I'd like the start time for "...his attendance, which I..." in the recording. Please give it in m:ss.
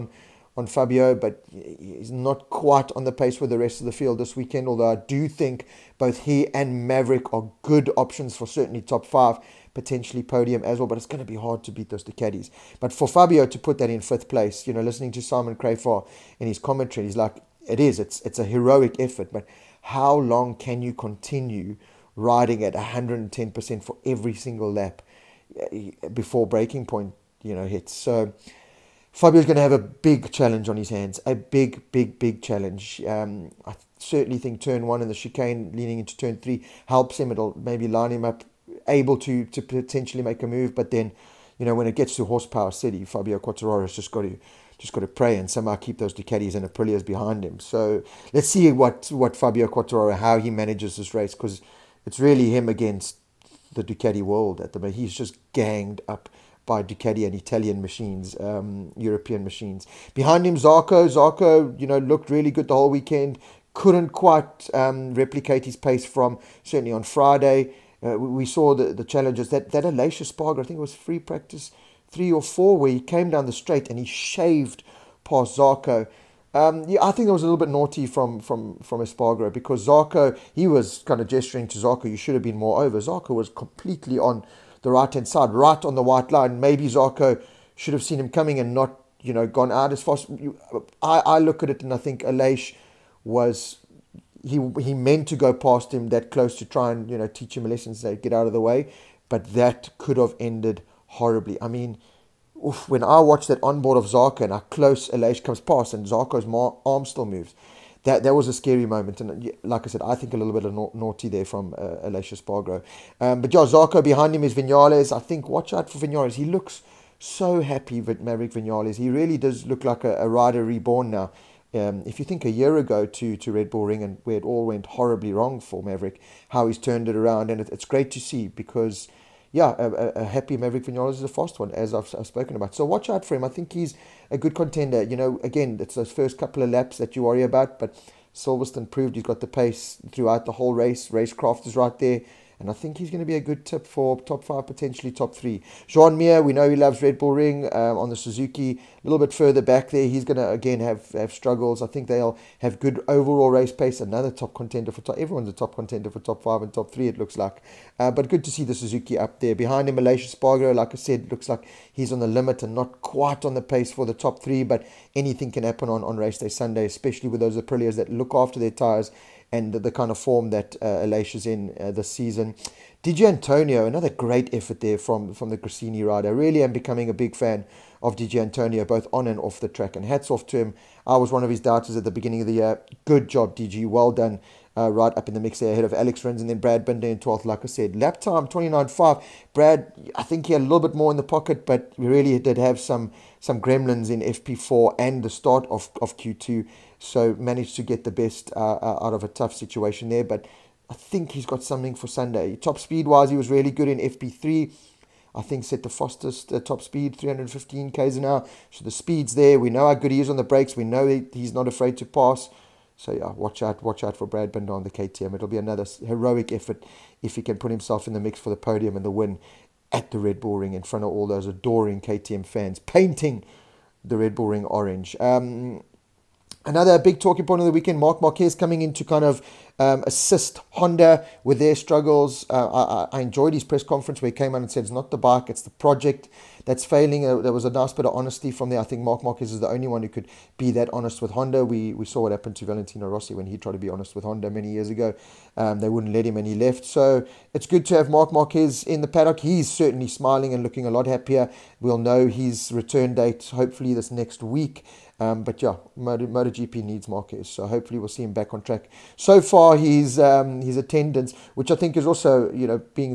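4:20.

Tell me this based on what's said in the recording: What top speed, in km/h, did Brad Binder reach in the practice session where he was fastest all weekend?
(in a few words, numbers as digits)
315.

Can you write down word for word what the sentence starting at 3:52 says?
Uh, I, I, enjoyed his press conference where he came out and said it's not the bike, it's the project that's failing.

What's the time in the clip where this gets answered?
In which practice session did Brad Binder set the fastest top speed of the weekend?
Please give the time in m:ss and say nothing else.
3:23.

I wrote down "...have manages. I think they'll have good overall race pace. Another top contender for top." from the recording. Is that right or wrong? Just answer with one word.
wrong.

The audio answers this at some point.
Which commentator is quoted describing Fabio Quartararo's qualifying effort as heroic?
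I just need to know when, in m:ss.
0:15.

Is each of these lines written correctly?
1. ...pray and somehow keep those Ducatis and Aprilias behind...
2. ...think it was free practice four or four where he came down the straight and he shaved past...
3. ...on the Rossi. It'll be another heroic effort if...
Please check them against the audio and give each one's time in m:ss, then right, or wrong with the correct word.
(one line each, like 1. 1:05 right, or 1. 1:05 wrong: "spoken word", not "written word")
1. 0:45 right
2. 1:10 wrong: "three", not "four"
3. 3:34 wrong: "KTM", not "Rossi".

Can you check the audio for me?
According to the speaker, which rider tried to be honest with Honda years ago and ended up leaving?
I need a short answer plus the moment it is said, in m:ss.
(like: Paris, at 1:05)
Valentino Rossi, at 4:02.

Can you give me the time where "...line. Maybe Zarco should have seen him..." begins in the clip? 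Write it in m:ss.
1:26.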